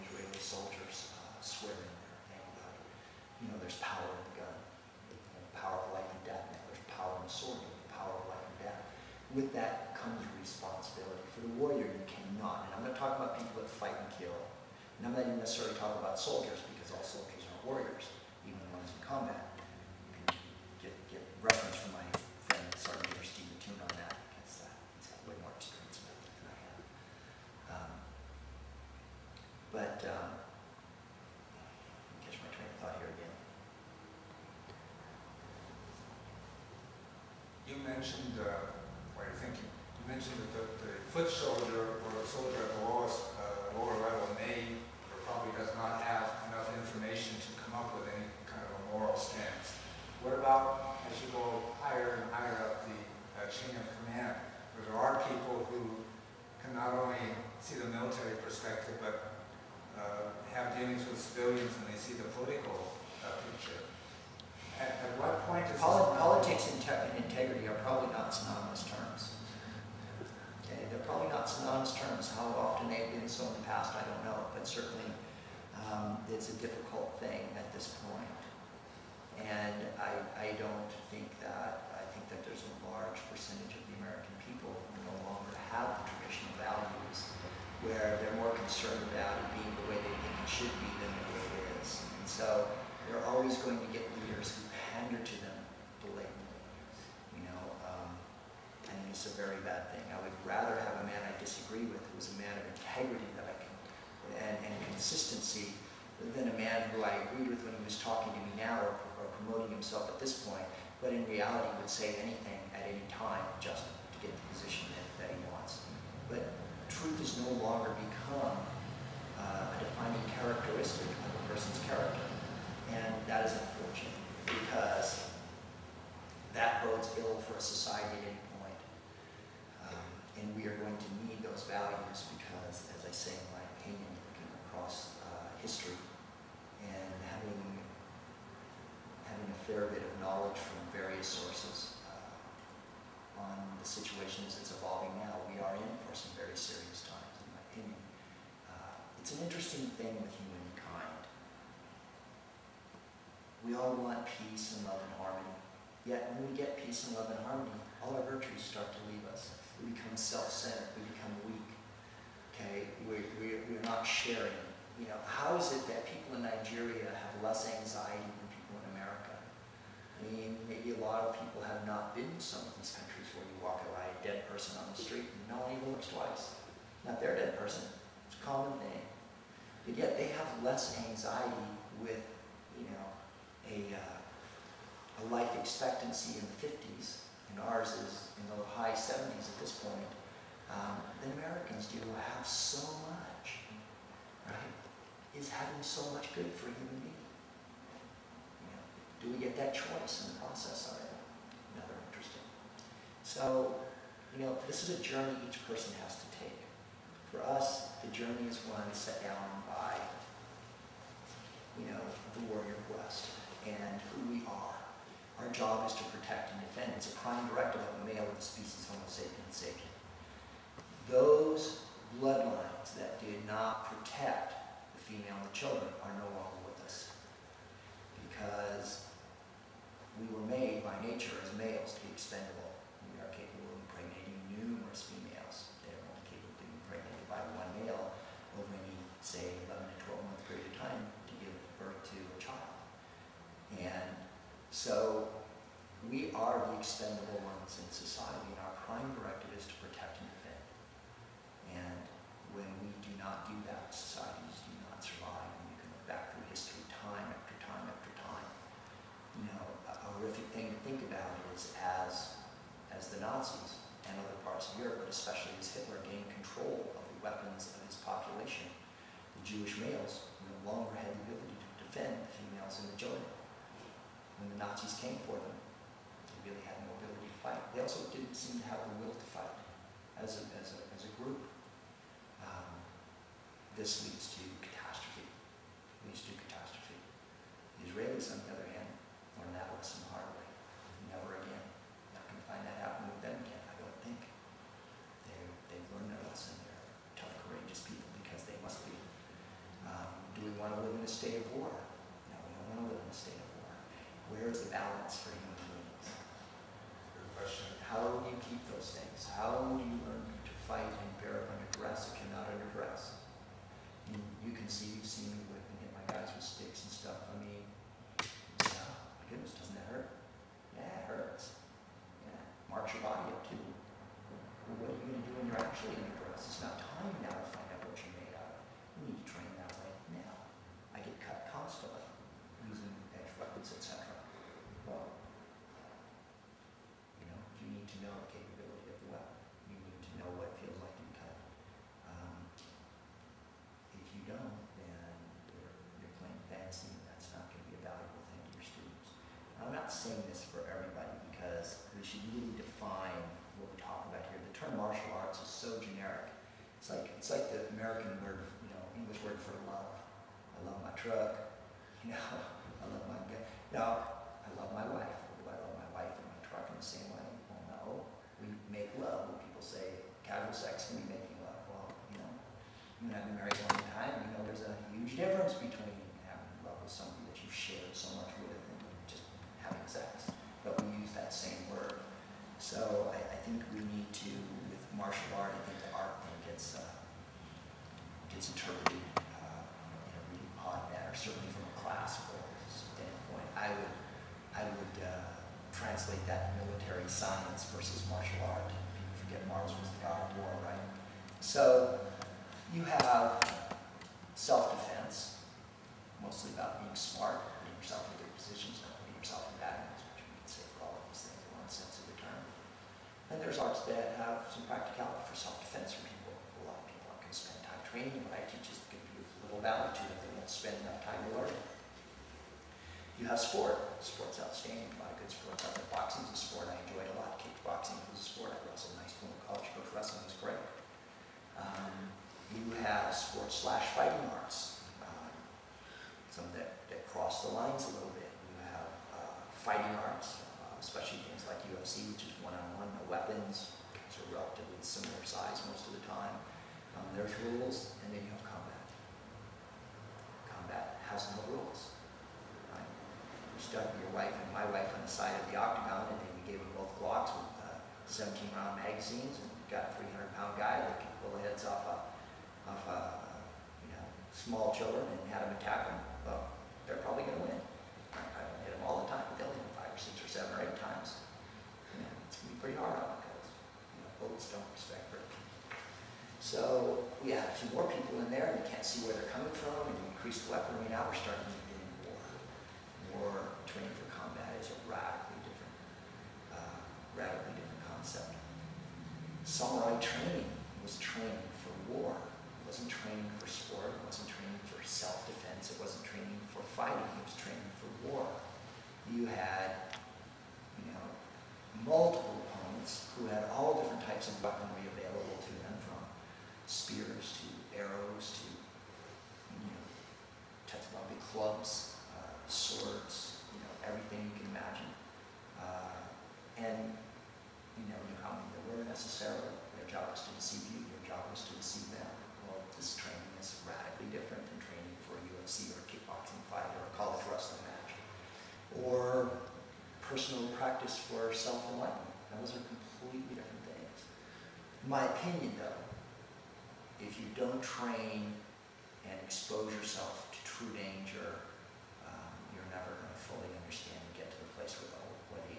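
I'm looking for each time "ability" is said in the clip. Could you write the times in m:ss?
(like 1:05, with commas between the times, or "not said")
4:31, 4:36.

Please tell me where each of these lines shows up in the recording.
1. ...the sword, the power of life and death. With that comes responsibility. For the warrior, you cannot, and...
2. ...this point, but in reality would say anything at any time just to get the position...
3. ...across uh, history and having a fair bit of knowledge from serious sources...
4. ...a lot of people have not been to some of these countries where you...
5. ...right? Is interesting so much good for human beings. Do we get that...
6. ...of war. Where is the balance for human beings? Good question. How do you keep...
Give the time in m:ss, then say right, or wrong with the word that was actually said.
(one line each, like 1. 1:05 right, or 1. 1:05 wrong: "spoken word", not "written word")
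1. 0:07 right
2. 1:50 right
3. 2:14 wrong: "various", not "serious"
4. 2:50 right
5. 3:14 wrong: "having", not "interesting"
6. 5:03 right.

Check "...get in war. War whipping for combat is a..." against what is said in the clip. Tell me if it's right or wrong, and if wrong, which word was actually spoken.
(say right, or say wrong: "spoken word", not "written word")
wrong: "training", not "whipping".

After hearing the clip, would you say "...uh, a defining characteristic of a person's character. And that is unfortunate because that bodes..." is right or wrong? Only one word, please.
right.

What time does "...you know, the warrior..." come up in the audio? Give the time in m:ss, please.
3:31.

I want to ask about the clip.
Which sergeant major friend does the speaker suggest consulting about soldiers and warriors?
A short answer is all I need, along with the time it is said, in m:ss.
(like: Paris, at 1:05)
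Steve Tune, at 0:23.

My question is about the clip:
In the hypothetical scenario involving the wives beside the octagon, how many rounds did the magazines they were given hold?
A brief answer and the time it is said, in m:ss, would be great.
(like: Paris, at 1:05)
17, at 7:38.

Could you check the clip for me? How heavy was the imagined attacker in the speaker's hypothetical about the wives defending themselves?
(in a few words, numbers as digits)
300 pounds.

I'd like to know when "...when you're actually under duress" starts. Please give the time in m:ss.
5:25.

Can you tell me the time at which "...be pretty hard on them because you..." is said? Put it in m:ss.
7:52.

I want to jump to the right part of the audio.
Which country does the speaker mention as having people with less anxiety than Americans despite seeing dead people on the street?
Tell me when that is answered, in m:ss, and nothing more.
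2:46.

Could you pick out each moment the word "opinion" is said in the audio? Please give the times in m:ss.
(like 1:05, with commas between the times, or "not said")
2:13, 2:27, 8:55.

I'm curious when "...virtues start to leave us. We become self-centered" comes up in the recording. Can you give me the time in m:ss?
2:38.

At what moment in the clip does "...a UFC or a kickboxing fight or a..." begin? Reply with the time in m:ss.
8:45.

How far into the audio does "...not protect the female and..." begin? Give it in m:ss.
3:43.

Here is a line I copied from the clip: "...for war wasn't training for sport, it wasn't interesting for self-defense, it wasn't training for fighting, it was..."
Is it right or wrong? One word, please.
wrong.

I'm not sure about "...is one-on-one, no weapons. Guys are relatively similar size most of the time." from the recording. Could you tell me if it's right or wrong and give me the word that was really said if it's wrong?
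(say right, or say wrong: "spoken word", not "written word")
right.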